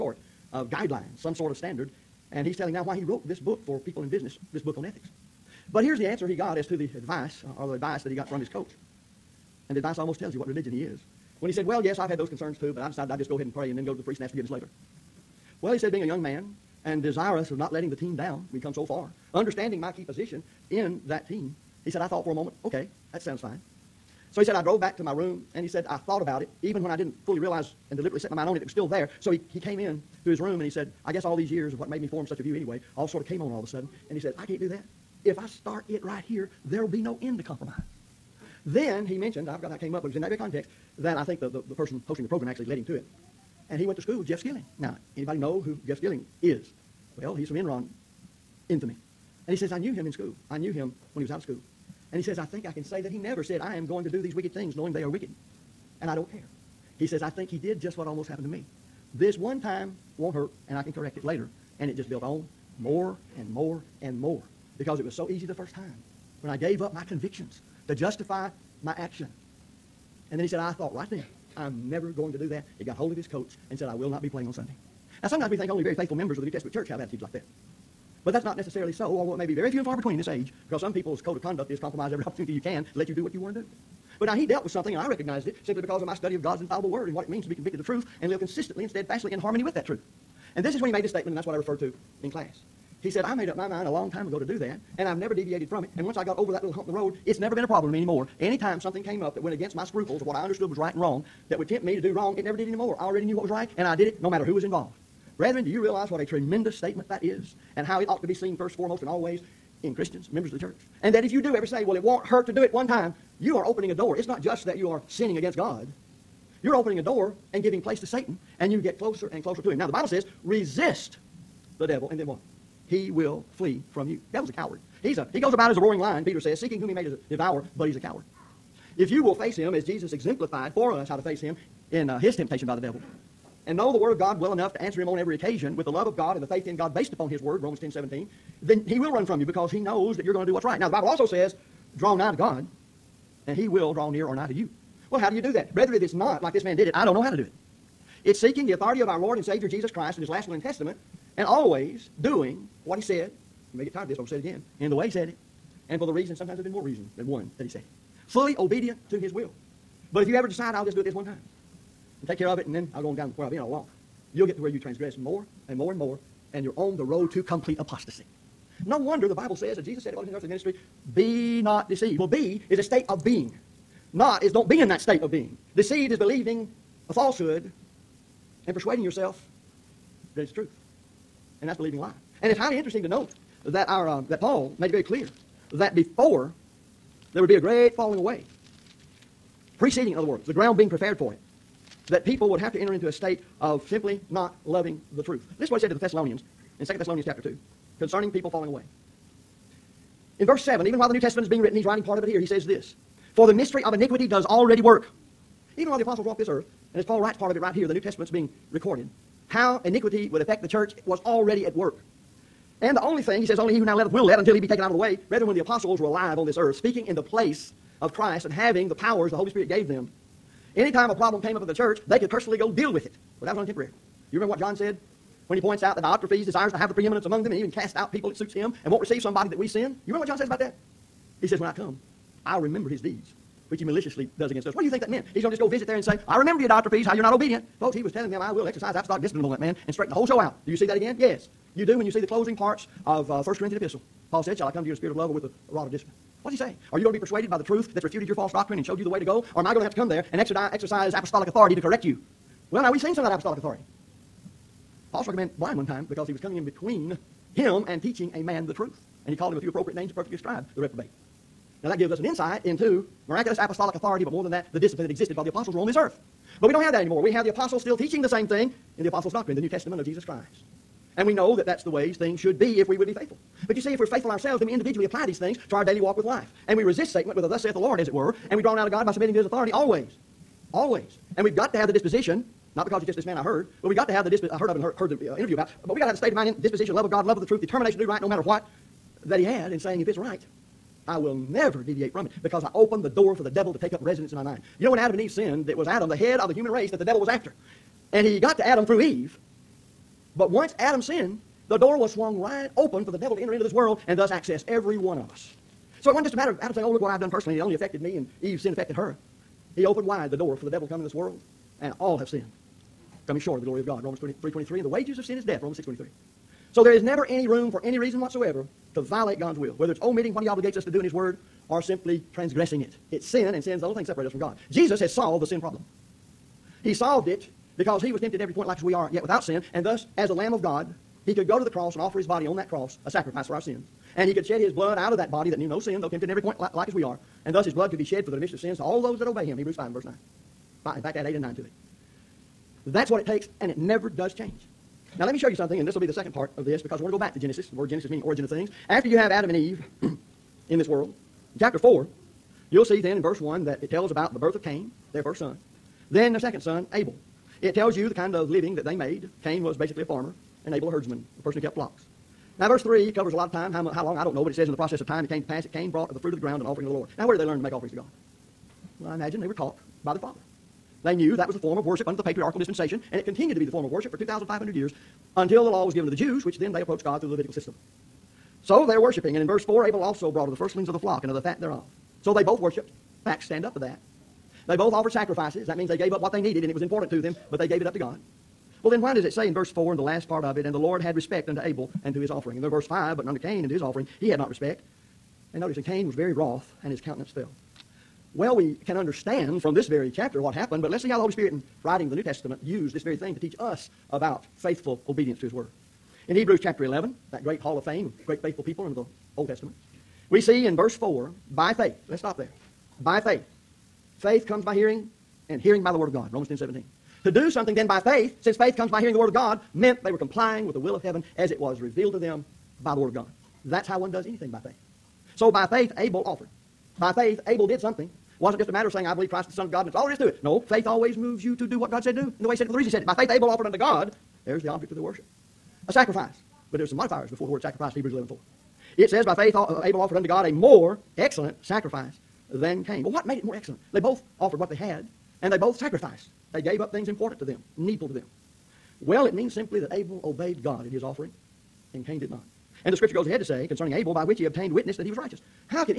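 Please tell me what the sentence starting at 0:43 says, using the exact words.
And he went to school with Jeff Skilling.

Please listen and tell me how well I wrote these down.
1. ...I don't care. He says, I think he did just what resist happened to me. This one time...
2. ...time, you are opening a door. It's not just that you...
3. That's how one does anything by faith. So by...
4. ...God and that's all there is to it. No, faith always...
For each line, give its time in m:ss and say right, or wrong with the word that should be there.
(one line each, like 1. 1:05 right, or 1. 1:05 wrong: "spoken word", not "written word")
1. 0:56 wrong: "almost", not "resist"
2. 1:52 right
3. 7:03 right
4. 7:09 right.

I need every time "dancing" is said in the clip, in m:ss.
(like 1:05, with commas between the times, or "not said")
not said.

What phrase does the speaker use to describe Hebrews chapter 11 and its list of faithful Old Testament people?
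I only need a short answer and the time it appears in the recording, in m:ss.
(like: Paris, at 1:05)
Hall of fame, at 6:47.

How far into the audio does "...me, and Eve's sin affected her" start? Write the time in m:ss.
5:08.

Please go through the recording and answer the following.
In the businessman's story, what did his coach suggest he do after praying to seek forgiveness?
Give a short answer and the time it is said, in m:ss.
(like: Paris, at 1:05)
Go to the priest, at 0:13.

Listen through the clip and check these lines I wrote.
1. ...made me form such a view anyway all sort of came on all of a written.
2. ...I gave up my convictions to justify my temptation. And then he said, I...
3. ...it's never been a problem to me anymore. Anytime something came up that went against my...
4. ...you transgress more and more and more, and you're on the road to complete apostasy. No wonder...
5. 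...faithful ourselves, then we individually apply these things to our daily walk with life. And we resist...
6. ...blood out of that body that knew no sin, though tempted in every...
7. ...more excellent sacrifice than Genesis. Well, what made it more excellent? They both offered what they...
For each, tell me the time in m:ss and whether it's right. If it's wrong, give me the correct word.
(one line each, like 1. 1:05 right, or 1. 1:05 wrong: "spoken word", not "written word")
1. 0:31 wrong: "sudden", not "written"
2. 1:06 wrong: "action", not "temptation"
3. 1:37 right
4. 2:44 right
5. 4:34 right
6. 5:34 right
7. 7:20 wrong: "Cain", not "Genesis".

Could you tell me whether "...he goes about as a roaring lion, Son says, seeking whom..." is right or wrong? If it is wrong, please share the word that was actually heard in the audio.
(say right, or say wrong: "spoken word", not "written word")
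wrong: "Peter", not "Son".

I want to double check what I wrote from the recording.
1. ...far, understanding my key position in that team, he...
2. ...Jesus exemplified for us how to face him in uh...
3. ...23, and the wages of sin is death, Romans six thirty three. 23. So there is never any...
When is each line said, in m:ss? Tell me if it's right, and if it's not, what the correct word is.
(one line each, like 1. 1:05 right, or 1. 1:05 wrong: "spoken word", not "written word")
1. 0:18 right
2. 2:09 right
3. 5:14 wrong: "twenty", not "thirty".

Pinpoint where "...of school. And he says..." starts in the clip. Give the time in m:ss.
0:51.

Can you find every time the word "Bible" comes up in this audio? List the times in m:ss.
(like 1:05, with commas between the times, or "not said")
1:59, 2:20, 2:49.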